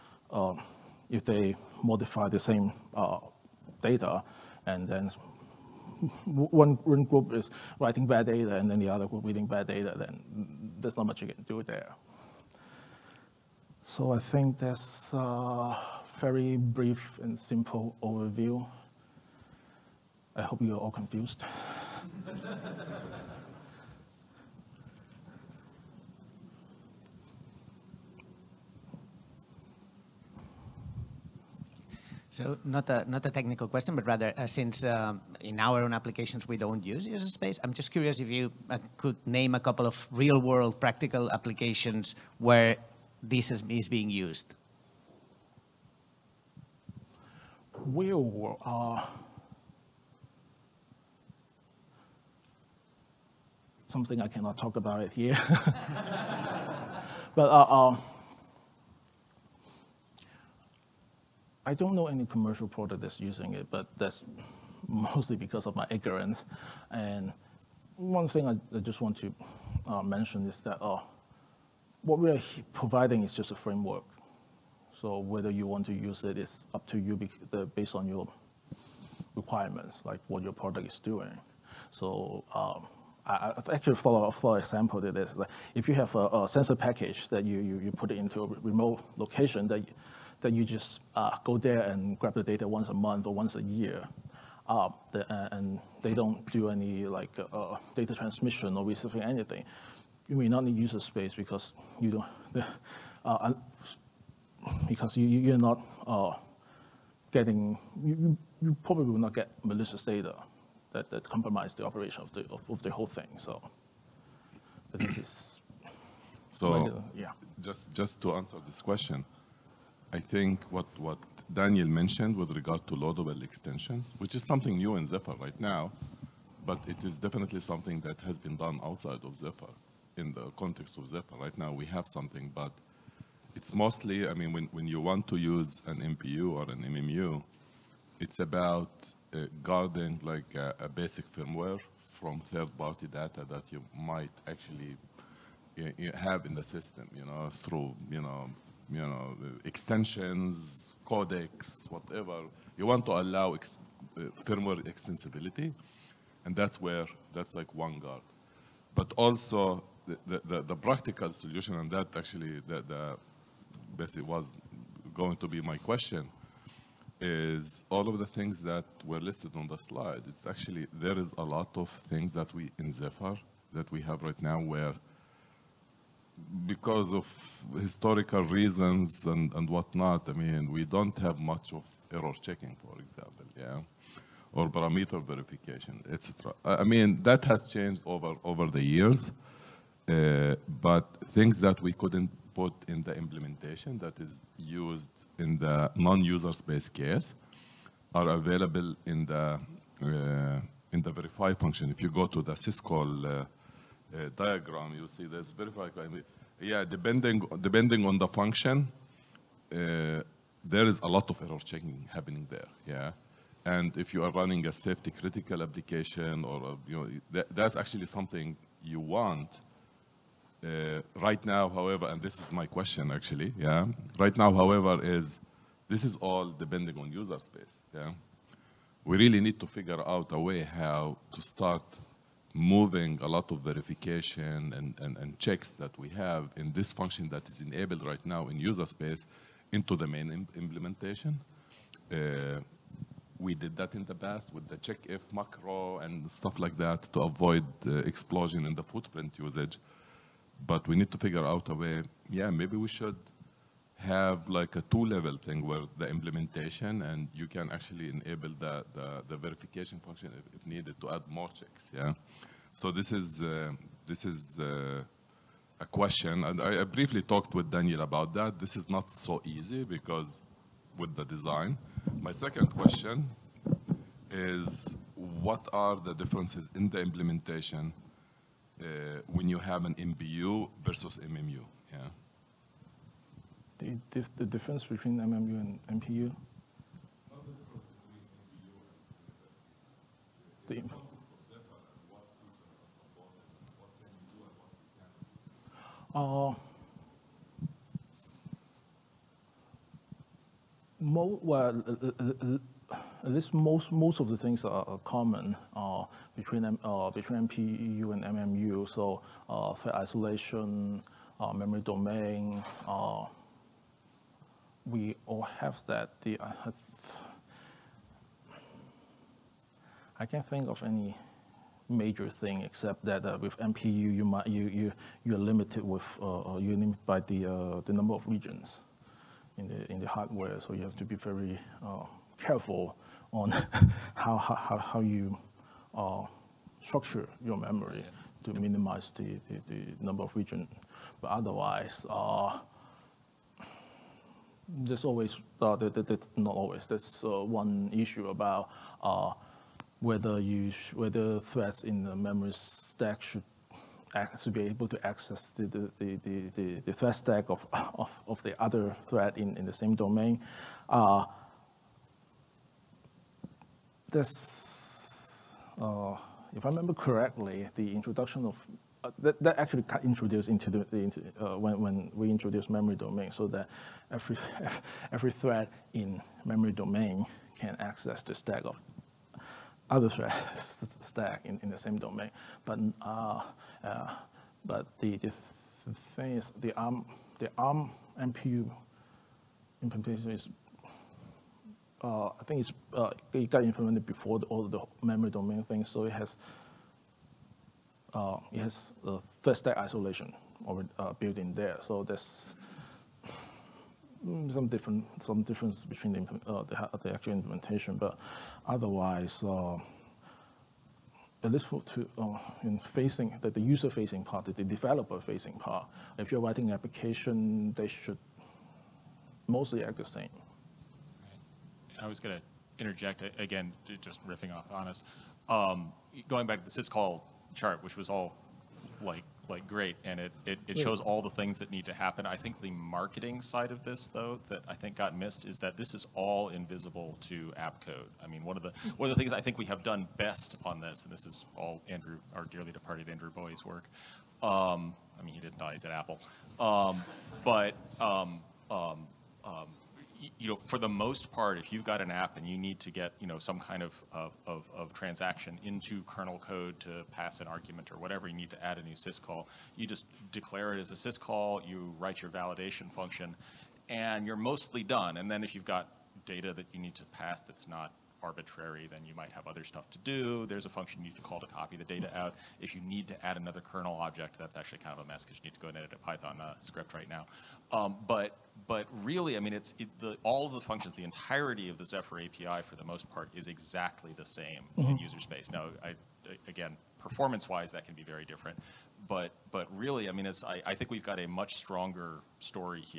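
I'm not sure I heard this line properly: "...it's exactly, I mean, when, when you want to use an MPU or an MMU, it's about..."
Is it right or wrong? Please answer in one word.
wrong.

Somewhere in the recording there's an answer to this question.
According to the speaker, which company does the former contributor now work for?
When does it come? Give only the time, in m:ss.
7:25.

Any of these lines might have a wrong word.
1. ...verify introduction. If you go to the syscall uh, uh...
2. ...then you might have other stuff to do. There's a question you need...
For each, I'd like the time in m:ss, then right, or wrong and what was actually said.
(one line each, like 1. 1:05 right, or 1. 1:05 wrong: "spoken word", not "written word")
1. 3:21 wrong: "function", not "introduction"
2. 7:48 wrong: "function", not "question".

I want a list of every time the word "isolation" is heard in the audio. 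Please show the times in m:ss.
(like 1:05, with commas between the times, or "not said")
5:09, 6:39.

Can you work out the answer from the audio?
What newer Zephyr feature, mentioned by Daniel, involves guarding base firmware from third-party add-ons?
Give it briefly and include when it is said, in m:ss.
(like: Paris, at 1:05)
loadable extensions, at 2:02.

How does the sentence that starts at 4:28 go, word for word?
This is not so easy because with the design.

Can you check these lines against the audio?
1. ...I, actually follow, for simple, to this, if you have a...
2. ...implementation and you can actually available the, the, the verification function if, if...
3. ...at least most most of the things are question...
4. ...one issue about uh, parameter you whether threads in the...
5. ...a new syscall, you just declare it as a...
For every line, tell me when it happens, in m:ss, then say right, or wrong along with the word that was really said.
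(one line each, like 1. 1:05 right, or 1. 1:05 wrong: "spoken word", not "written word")
1. 1:23 wrong: "example", not "simple"
2. 4:16 wrong: "enable", not "available"
3. 5:03 wrong: "common", not "question"
4. 5:47 wrong: "whether", not "parameter"
5. 7:38 right.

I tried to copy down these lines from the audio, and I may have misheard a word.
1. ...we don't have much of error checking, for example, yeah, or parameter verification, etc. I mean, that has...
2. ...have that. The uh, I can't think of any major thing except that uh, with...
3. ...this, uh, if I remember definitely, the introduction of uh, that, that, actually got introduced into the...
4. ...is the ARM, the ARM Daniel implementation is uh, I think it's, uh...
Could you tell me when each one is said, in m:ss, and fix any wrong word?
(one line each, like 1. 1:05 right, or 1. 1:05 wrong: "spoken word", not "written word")
1. 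3:00 right
2. 5:15 right
3. 6:04 wrong: "correctly", not "definitely"
4. 6:26 wrong: "MPU", not "Daniel".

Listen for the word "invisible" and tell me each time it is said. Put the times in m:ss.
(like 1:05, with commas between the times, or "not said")
7:16.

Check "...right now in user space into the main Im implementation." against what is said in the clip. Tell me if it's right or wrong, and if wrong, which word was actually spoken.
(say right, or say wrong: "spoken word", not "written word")
right.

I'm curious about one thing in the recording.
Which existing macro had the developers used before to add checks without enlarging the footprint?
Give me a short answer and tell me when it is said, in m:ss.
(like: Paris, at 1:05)
check if macro, at 4:04.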